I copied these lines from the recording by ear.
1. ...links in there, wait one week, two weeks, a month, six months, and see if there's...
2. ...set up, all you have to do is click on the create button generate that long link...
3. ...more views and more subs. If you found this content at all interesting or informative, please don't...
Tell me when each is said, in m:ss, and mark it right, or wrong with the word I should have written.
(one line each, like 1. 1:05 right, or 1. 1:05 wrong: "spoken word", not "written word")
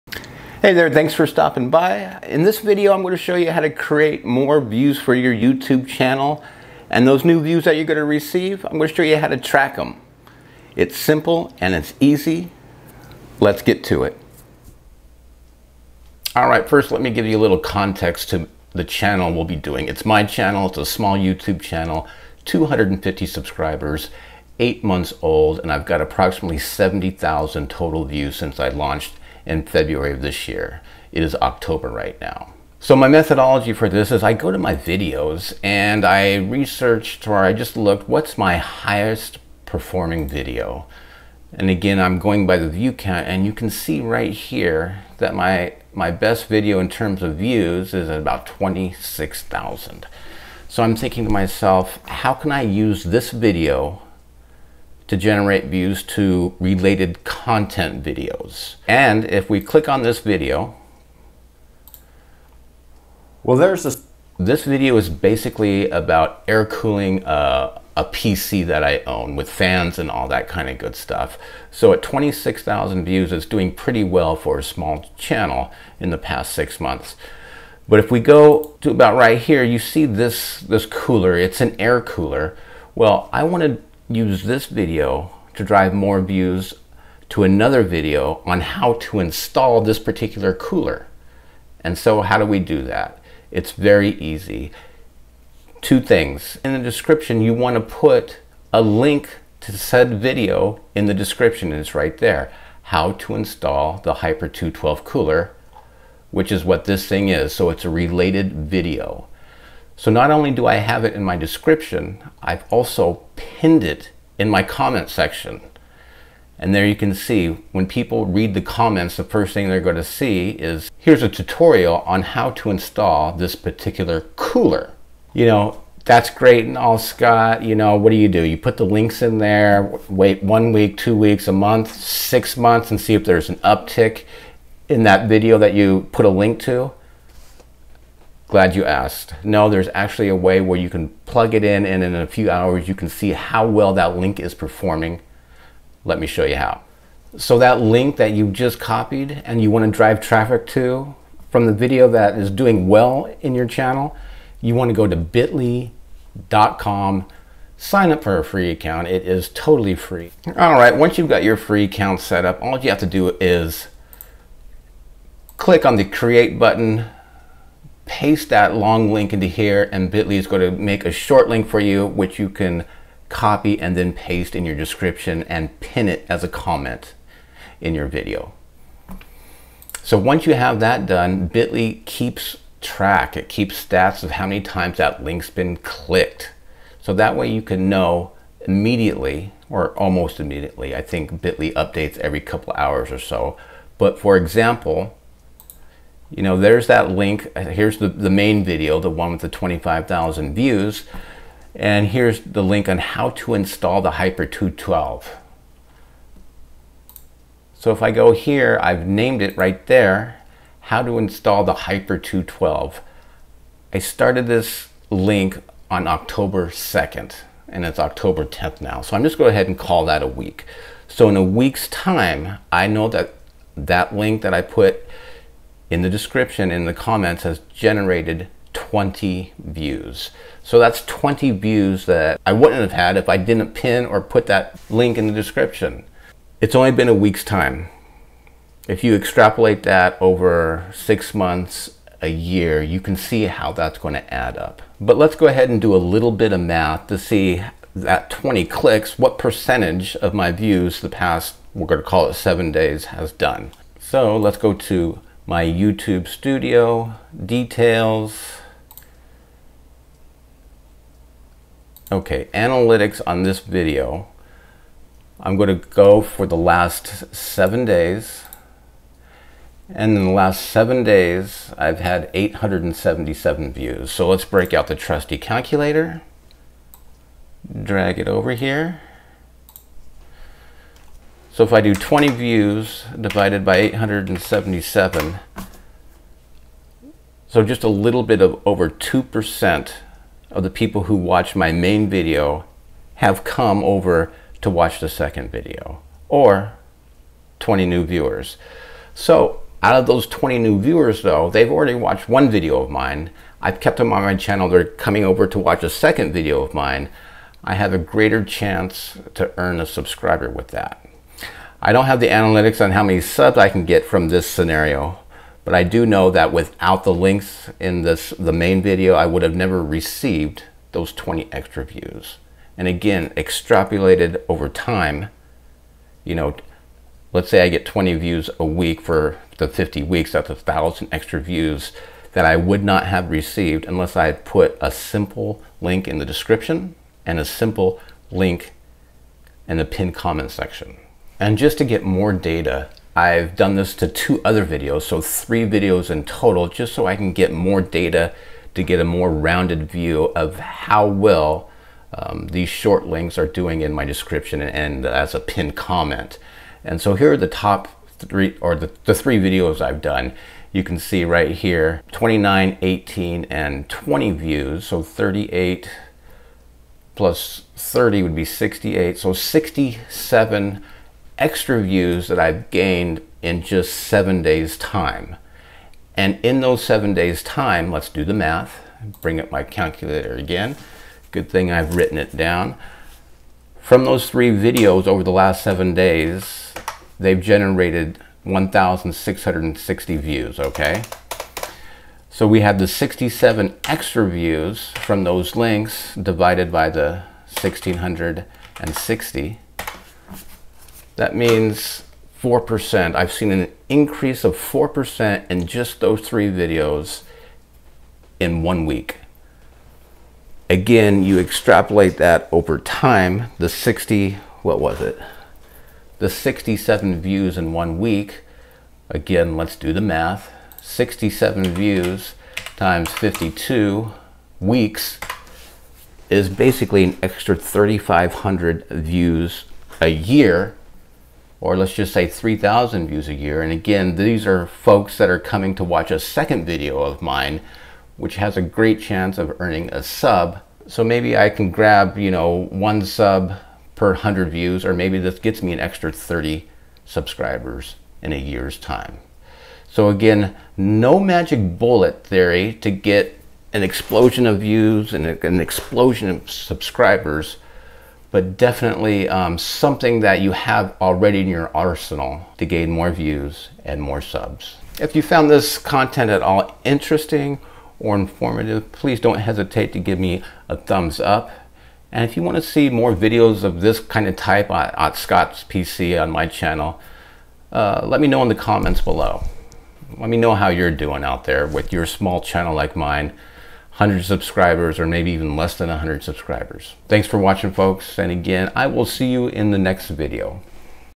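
1. 2:08 right
2. 2:42 wrong: "paste", not "generate"
3. 7:42 right.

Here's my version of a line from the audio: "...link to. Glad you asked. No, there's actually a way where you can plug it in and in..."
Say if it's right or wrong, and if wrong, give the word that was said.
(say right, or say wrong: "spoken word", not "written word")
right.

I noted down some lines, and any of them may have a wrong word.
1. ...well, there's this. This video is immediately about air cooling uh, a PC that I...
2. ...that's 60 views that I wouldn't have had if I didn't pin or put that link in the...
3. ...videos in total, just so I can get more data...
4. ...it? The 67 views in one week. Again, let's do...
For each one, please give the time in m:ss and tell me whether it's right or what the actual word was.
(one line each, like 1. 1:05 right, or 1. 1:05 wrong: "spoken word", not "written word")
1. 1:03 wrong: "basically", not "immediately"
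2. 3:50 wrong: "20", not "60"
3. 5:45 right
4. 6:54 right.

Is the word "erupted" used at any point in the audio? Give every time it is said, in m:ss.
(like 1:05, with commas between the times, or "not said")
not said.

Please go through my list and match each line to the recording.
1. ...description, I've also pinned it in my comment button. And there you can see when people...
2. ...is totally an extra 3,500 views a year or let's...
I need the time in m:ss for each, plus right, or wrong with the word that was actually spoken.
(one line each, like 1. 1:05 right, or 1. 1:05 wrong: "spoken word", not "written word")
1. 1:51 wrong: "section", not "button"
2. 7:06 wrong: "basically", not "totally".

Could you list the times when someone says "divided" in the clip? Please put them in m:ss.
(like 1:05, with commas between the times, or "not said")
4:43, 6:36.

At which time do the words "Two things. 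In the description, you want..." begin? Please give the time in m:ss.
1:35.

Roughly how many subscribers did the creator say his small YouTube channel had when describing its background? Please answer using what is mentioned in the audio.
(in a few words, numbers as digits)
250.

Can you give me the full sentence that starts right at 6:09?
So 67 extra views that I've gained in just seven days time.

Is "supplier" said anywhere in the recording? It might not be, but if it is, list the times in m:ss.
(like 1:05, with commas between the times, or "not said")
not said.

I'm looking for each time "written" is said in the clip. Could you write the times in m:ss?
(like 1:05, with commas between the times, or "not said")
6:21.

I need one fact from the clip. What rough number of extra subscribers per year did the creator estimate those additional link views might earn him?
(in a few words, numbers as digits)
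30.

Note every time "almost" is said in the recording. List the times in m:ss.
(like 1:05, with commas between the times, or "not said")
3:09.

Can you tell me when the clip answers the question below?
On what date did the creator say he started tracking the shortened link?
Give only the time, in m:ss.
3:36.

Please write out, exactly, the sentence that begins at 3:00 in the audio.
So once you have that done, Bitly keeps track.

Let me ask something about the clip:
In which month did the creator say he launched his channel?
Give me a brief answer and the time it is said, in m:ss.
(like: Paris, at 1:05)
February, at 0:29.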